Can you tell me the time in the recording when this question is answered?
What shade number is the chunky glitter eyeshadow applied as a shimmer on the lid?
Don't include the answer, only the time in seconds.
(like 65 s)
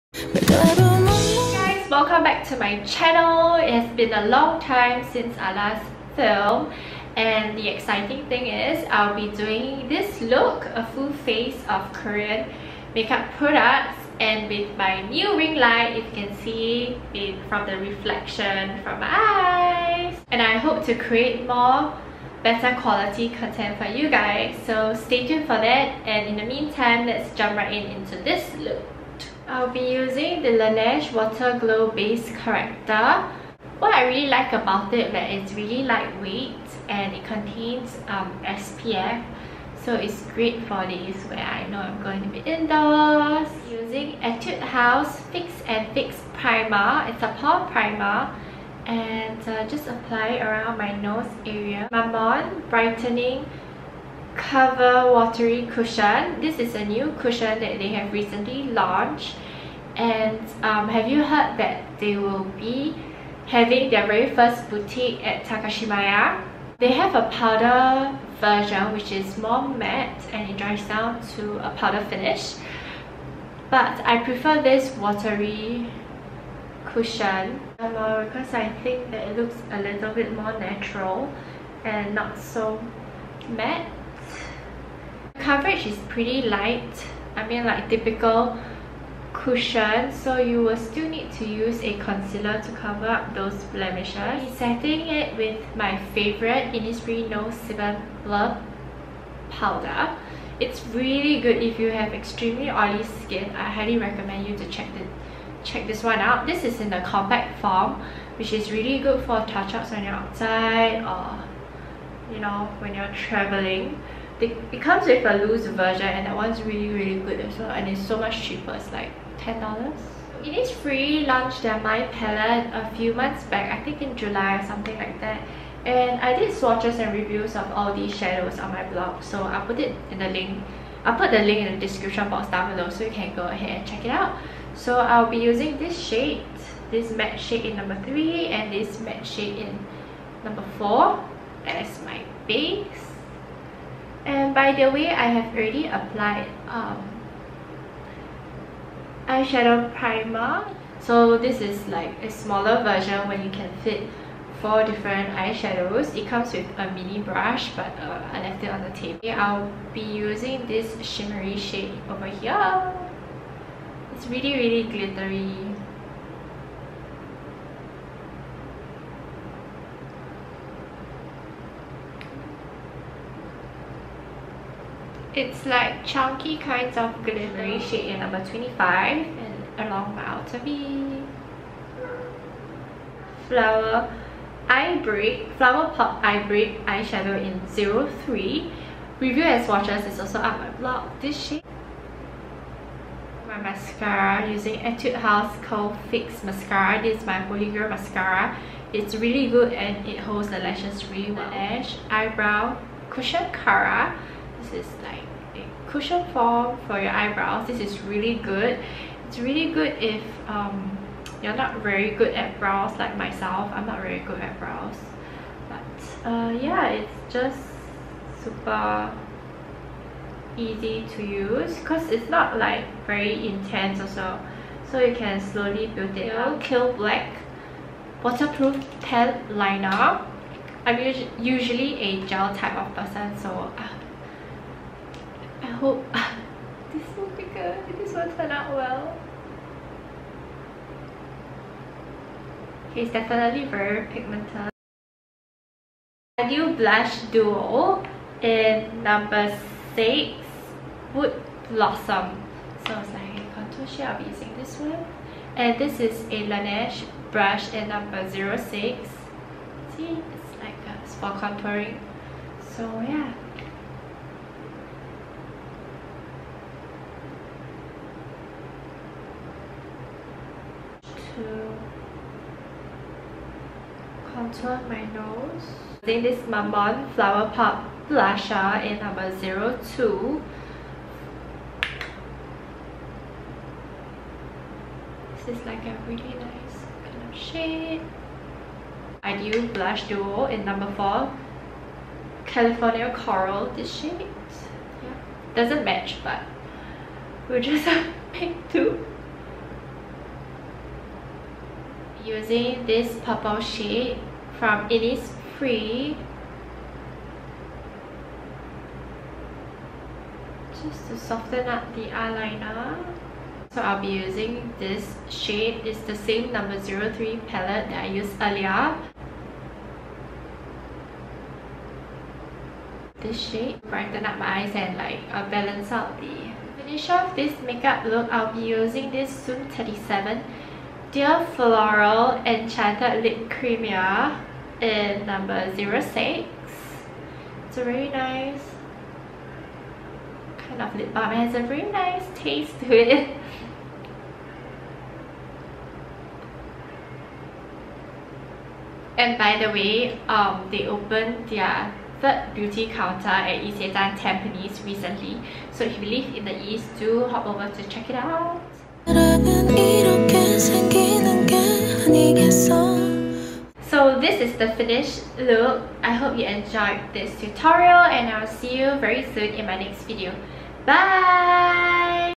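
178 s.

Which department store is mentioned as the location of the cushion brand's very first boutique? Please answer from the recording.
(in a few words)
Takashimaya.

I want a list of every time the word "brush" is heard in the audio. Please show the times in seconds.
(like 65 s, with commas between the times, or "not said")
157 s, 257 s.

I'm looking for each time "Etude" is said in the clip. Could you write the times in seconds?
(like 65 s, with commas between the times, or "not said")
44 s, 194 s.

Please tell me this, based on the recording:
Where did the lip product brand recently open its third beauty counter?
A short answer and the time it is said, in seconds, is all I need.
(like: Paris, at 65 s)
Isetan Tampines, at 353 s.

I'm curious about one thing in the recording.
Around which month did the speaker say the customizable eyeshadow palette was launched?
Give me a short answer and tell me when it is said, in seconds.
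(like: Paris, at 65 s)
July, at 124 s.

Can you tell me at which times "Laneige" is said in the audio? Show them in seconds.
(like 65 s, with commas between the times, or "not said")
30 s, 256 s.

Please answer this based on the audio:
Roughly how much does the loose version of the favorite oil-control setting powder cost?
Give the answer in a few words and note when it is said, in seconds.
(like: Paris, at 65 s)
$10, at 119 s.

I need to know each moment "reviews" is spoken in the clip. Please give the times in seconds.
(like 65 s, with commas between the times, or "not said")
127 s, 189 s.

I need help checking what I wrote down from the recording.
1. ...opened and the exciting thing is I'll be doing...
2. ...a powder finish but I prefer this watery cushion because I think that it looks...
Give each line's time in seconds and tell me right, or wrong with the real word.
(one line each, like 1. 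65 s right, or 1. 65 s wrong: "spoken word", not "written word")
1. 6 s wrong: "filmed", not "opened"
2. 71 s right.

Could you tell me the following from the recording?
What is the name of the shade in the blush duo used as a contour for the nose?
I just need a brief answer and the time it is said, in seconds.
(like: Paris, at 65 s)
Wood Blossom, at 251 s.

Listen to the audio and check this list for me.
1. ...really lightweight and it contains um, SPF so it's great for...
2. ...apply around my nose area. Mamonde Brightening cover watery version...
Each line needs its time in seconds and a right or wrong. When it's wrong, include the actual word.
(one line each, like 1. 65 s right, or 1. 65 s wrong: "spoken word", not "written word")
1. 35 s right
2. 49 s wrong: "cushion", not "version".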